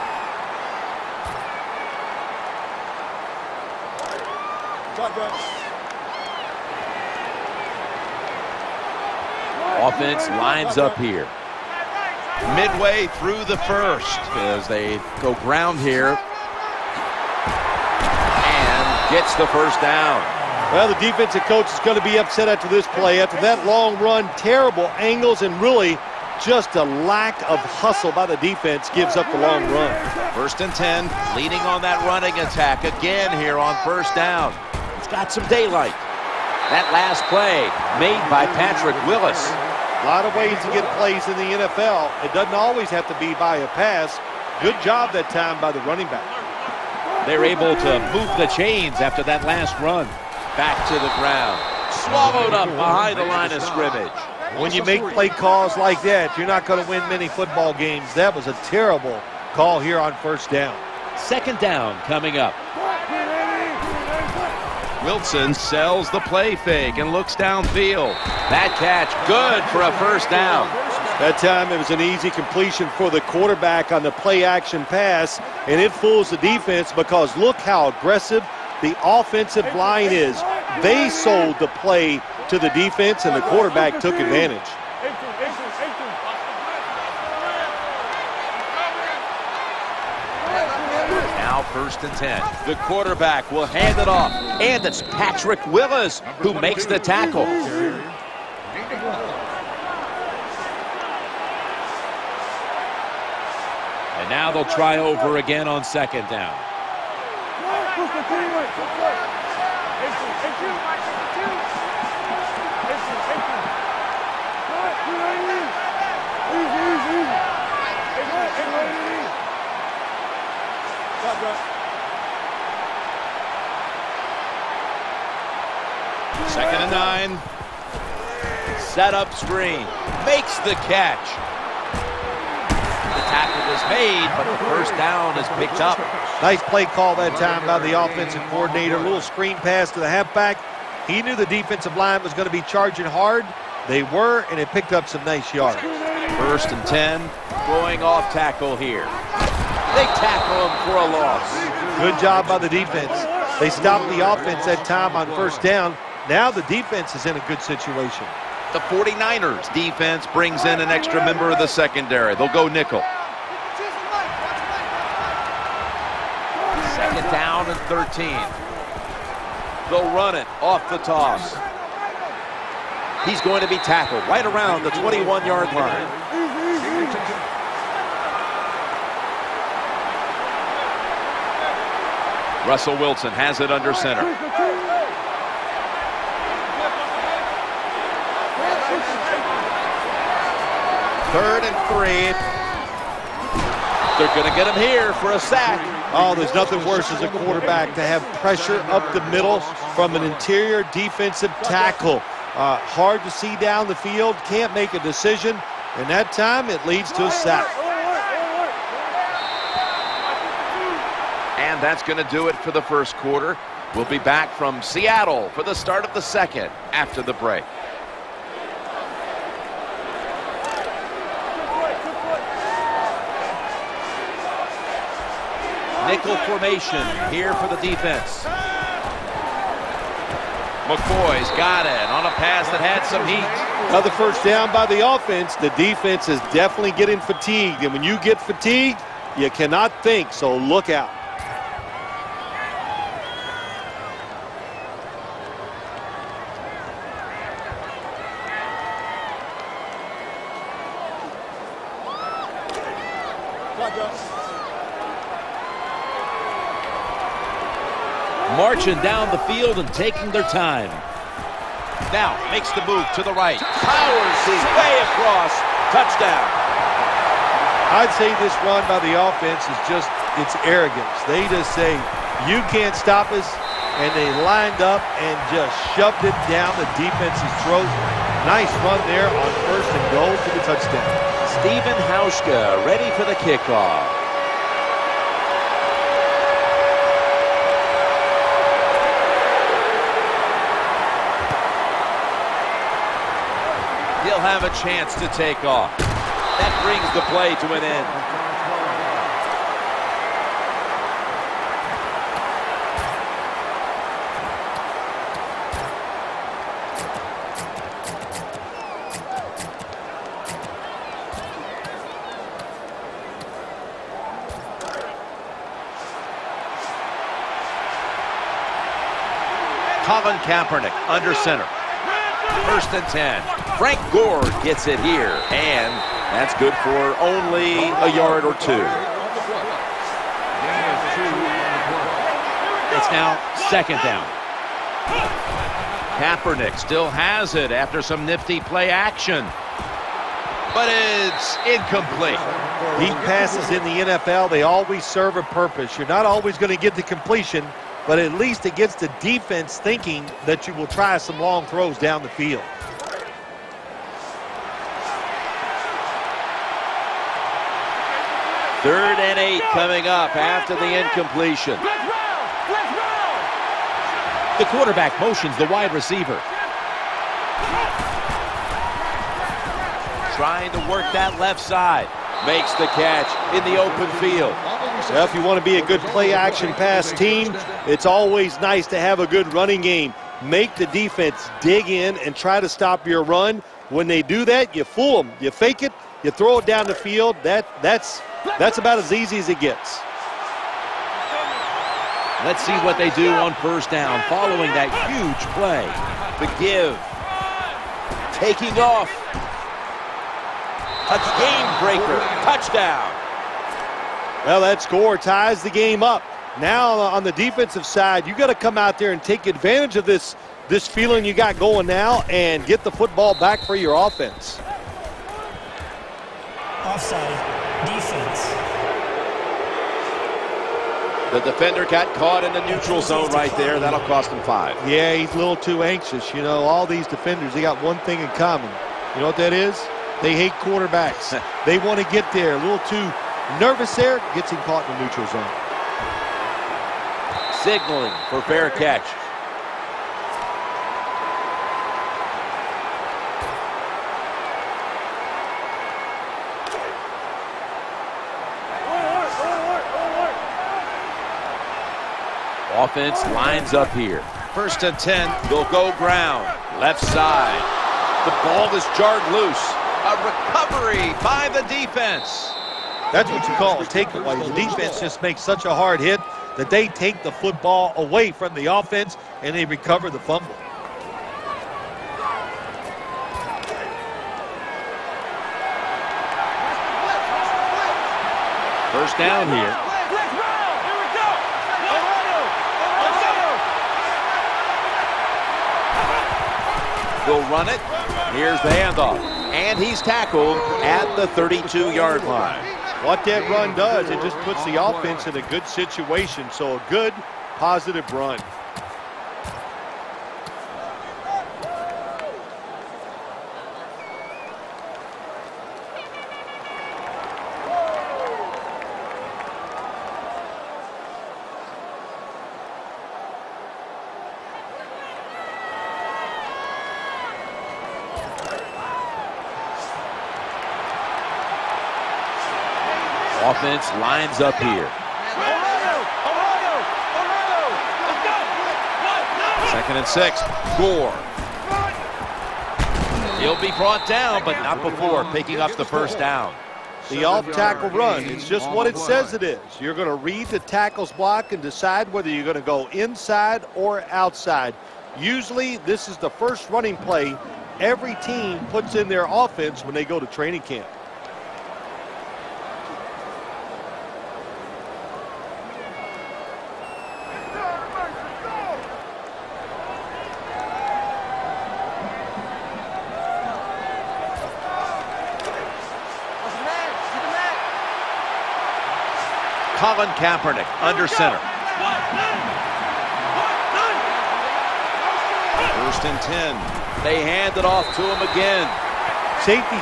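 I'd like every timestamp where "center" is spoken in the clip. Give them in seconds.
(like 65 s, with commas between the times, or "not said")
183 s, 321 s, 571 s.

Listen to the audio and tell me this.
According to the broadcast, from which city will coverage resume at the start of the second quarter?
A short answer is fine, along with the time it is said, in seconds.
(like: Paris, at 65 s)
Seattle, at 214 s.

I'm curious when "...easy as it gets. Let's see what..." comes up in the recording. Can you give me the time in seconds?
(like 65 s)
389 s.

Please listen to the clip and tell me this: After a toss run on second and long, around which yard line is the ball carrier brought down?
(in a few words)
21.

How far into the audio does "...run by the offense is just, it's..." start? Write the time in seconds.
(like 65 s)
268 s.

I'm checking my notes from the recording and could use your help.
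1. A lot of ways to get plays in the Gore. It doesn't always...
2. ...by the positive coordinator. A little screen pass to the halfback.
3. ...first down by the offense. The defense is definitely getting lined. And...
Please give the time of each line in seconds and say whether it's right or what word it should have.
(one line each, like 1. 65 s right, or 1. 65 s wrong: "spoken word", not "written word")
1. 39 s wrong: "NFL", not "Gore"
2. 137 s wrong: "offensive", not "positive"
3. 234 s wrong: "fatigued", not "lined".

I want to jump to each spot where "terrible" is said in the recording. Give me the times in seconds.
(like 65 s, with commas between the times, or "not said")
24 s, 58 s.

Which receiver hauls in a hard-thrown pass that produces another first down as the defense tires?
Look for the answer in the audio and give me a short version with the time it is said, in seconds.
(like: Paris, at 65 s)
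McCoy, at 230 s.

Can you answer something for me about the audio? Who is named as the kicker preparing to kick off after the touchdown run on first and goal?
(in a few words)
Stephen Hauschka.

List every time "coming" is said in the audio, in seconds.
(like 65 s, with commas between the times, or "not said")
62 s, 359 s.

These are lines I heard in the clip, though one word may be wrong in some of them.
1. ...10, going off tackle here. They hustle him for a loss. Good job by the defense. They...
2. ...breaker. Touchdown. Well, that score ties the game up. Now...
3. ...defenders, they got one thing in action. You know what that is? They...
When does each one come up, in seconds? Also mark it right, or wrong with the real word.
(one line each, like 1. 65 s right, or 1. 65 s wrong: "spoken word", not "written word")
1. 146 s wrong: "tackle", not "hustle"
2. 401 s right
3. 427 s wrong: "common", not "action".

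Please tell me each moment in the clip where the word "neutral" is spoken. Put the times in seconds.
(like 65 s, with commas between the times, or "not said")
422 s, 435 s.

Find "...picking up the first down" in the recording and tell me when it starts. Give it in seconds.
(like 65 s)
535 s.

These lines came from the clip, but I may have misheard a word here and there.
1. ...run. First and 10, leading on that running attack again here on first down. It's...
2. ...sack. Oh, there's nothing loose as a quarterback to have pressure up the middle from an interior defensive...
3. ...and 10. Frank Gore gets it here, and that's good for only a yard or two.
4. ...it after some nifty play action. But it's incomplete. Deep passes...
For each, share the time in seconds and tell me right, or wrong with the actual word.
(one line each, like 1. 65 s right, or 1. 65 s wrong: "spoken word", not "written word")
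1. 29 s right
2. 195 s wrong: "worse", not "loose"
3. 322 s right
4. 337 s right.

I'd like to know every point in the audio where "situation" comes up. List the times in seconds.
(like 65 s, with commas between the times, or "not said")
157 s, 495 s.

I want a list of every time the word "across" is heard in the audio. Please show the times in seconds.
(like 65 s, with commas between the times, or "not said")
265 s.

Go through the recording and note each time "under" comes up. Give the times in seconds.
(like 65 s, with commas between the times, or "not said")
183 s, 321 s, 570 s.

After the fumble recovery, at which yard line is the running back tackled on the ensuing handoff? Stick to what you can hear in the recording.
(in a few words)
32.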